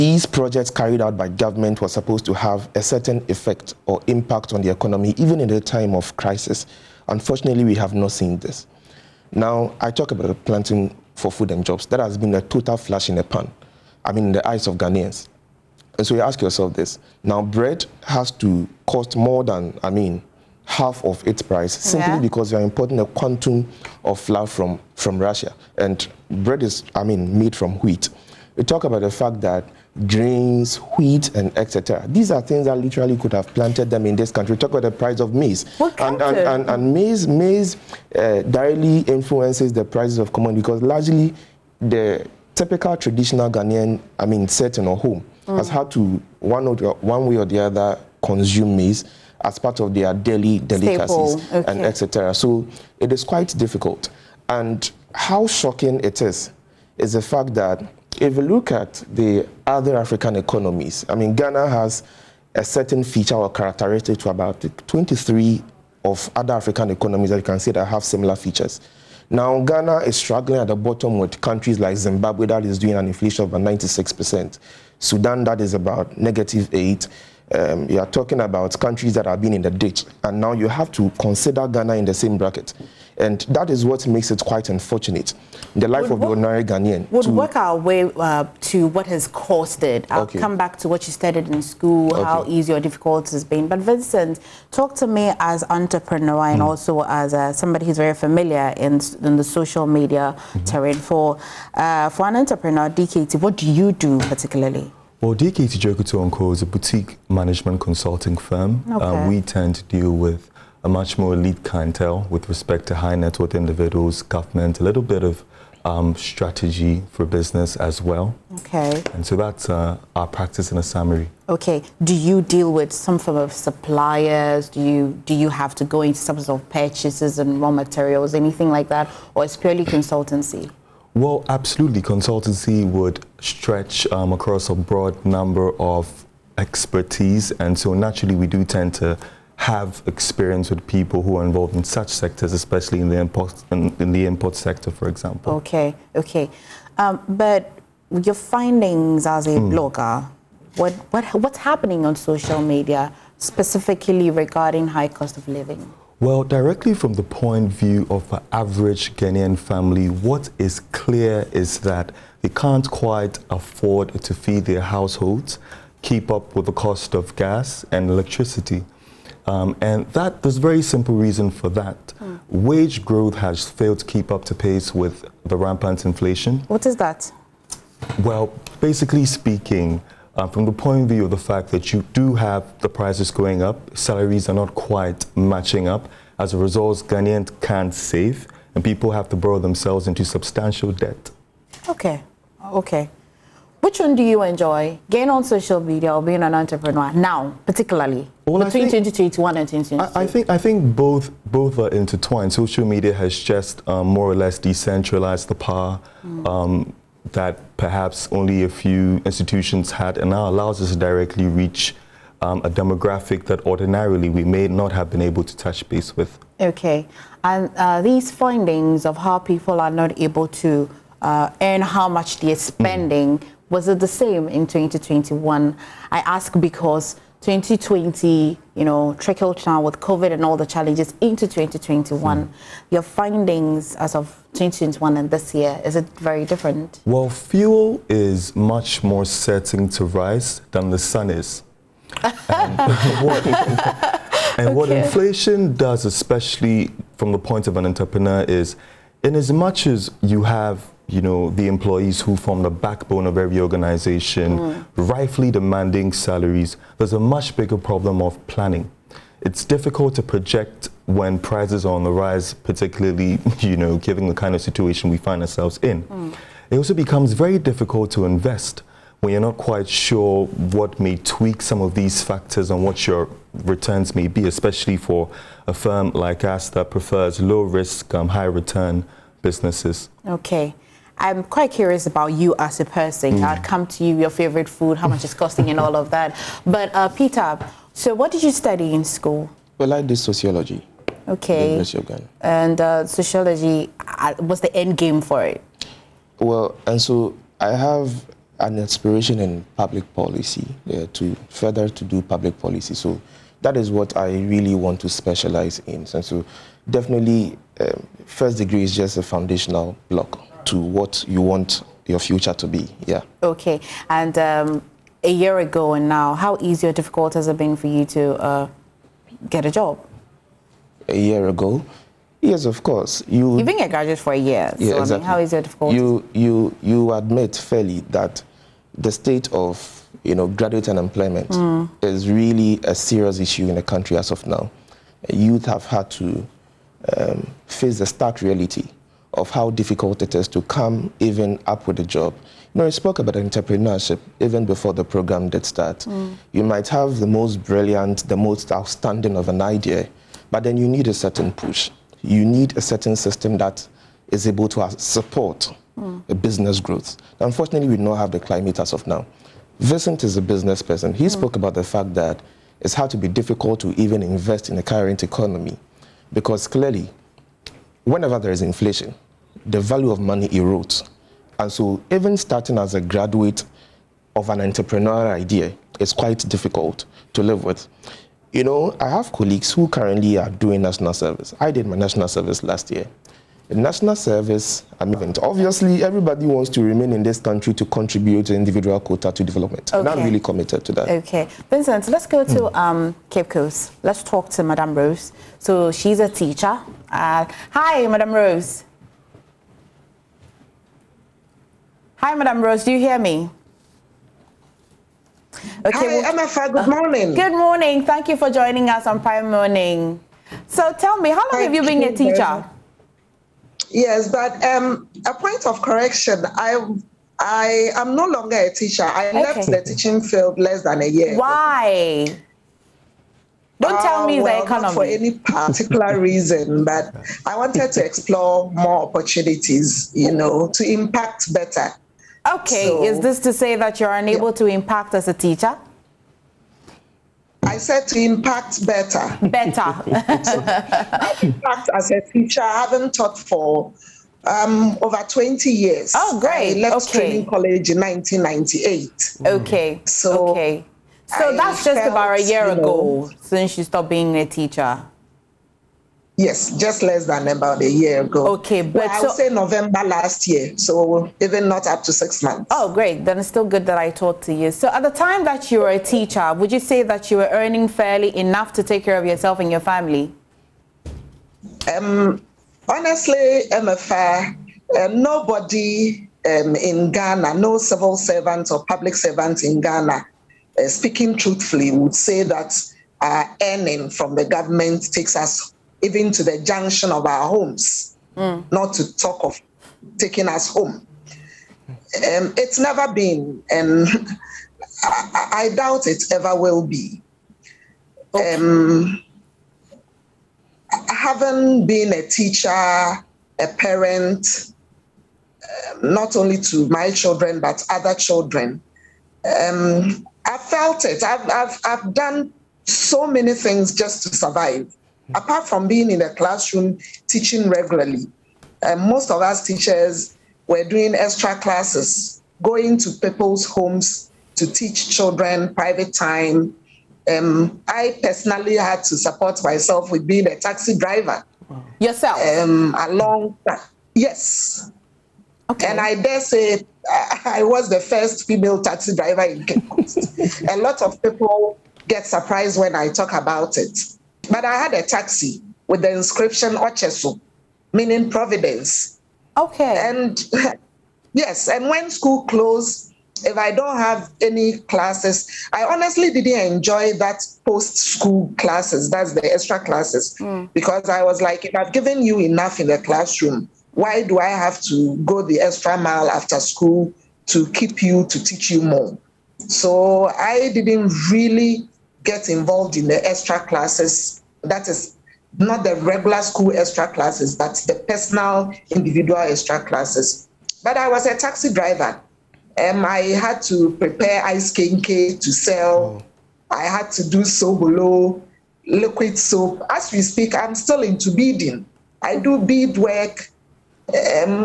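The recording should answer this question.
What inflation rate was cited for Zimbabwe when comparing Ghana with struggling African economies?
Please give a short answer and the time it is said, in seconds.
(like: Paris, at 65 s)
96%, at 73 s.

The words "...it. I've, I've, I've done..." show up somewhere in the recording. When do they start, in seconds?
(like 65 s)
511 s.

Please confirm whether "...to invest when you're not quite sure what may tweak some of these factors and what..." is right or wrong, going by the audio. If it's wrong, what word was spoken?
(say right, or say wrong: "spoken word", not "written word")
right.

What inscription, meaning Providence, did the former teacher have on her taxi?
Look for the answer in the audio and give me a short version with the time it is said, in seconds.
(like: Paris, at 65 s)
Ochesu, at 546 s.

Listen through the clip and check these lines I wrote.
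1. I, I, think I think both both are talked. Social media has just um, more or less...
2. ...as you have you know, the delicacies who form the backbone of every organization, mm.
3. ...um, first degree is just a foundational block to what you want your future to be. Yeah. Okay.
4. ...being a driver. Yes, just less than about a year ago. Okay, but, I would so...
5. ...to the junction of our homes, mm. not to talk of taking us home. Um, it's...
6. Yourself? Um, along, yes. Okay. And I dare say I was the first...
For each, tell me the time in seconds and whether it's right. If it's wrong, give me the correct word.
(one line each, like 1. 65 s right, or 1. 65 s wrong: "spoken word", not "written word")
1. 200 s wrong: "intertwined", not "talked"
2. 249 s wrong: "employees", not "delicacies"
3. 307 s right
4. 454 s wrong: "teacher", not "driver"
5. 486 s right
6. 532 s right.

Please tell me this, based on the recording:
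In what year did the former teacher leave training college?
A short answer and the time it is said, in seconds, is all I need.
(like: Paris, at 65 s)
1998, at 447 s.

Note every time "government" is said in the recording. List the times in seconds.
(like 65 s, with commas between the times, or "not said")
1 s, 114 s, 484 s.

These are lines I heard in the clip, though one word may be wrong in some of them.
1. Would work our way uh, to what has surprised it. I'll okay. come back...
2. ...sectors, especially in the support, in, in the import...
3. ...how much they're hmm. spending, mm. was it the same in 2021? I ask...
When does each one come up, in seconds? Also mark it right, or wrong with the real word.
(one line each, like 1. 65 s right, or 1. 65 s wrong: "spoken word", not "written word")
1. 87 s wrong: "caused", not "surprised"
2. 142 s wrong: "import", not "support"
3. 221 s right.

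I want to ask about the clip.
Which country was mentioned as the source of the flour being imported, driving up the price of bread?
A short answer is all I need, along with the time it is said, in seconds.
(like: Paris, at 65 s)
Russia, at 25 s.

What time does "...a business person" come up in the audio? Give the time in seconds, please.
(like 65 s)
360 s.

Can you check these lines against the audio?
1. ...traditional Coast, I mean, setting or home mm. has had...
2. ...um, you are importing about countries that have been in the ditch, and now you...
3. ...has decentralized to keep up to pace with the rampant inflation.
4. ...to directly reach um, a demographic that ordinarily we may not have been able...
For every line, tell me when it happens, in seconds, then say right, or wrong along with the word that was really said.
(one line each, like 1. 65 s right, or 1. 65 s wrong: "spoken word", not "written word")
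1. 42 s wrong: "Ghanaian", not "Coast"
2. 77 s wrong: "talking", not "importing"
3. 173 s wrong: "failed", not "decentralized"
4. 210 s right.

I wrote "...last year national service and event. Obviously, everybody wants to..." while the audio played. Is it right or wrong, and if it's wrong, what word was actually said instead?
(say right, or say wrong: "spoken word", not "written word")
right.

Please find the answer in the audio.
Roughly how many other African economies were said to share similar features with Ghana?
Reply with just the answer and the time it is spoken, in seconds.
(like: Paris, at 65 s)
23, at 64 s.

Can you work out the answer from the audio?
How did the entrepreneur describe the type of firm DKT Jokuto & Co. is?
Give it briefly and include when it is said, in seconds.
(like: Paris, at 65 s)
boutique management consulting firm, at 106 s.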